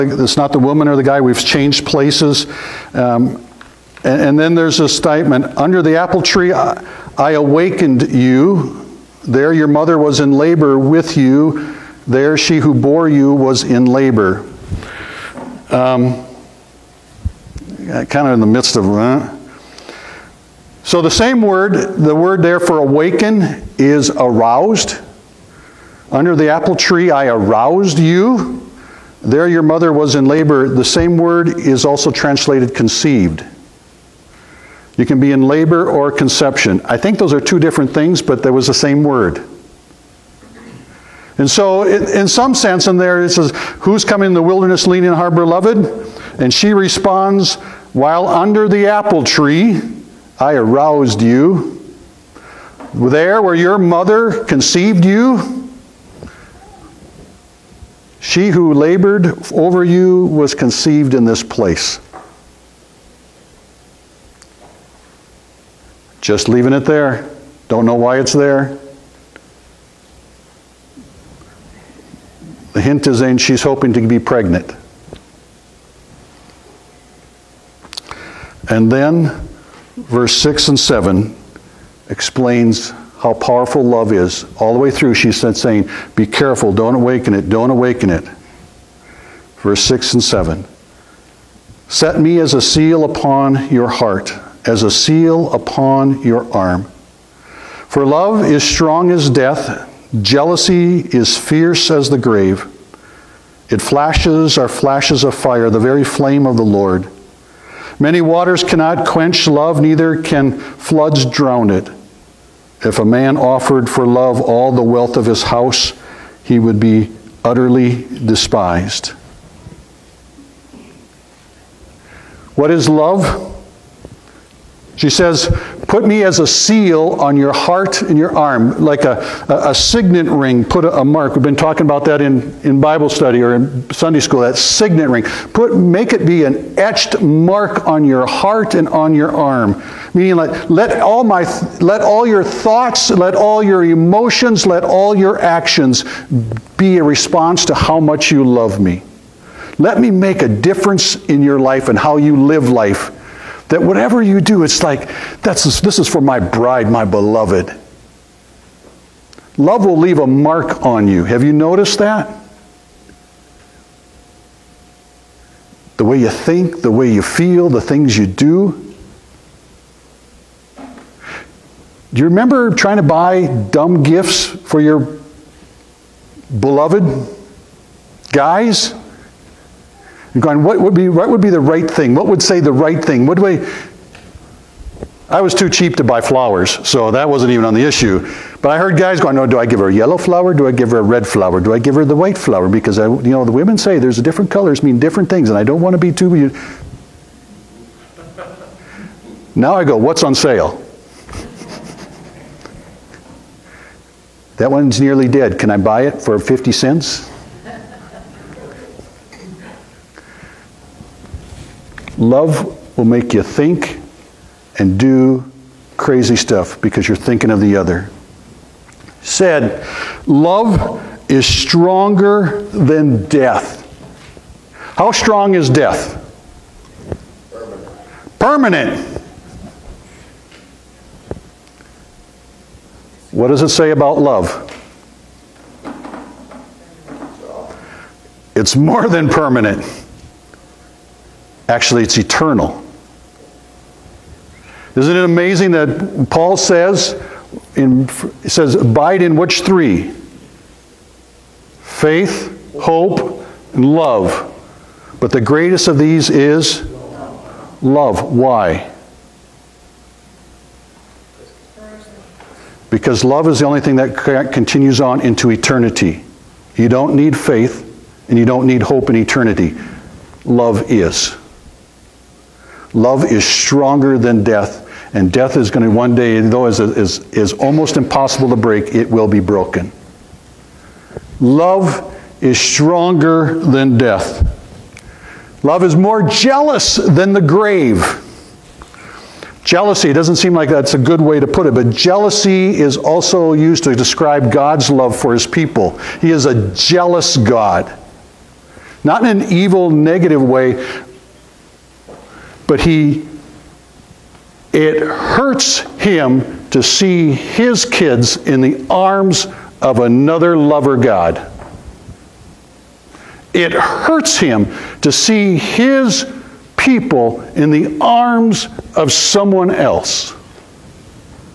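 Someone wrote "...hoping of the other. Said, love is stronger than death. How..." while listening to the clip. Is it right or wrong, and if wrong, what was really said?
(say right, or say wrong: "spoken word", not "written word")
wrong: "thinking", not "hoping".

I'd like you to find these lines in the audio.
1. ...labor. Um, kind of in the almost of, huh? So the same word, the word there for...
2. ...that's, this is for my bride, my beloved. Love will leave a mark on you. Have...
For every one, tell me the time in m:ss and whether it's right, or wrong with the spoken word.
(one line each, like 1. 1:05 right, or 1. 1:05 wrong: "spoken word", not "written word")
1. 0:13 wrong: "midst", not "almost"
2. 2:35 right.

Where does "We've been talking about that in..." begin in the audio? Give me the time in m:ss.
2:11.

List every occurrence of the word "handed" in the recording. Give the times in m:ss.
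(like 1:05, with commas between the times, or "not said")
not said.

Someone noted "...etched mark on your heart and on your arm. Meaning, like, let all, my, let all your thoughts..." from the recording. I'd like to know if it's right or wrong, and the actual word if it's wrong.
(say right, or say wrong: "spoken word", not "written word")
right.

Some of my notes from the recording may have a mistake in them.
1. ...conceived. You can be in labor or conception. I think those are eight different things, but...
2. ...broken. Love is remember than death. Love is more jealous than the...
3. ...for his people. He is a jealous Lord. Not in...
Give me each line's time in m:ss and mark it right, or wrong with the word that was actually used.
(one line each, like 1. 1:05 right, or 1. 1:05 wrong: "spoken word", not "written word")
1. 0:32 wrong: "two", not "eight"
2. 4:39 wrong: "stronger", not "remember"
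3. 4:55 wrong: "God", not "Lord".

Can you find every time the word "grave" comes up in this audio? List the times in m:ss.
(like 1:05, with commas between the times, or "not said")
1:42, 4:47.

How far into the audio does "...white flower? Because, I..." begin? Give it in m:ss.
3:12.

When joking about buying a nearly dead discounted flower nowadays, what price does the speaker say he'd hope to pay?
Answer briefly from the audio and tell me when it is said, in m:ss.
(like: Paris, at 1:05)
50 cents, at 3:26.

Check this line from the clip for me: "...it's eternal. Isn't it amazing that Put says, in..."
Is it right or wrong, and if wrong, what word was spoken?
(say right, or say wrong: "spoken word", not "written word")
wrong: "Paul", not "Put".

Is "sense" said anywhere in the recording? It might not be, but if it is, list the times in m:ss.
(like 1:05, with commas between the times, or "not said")
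0:42.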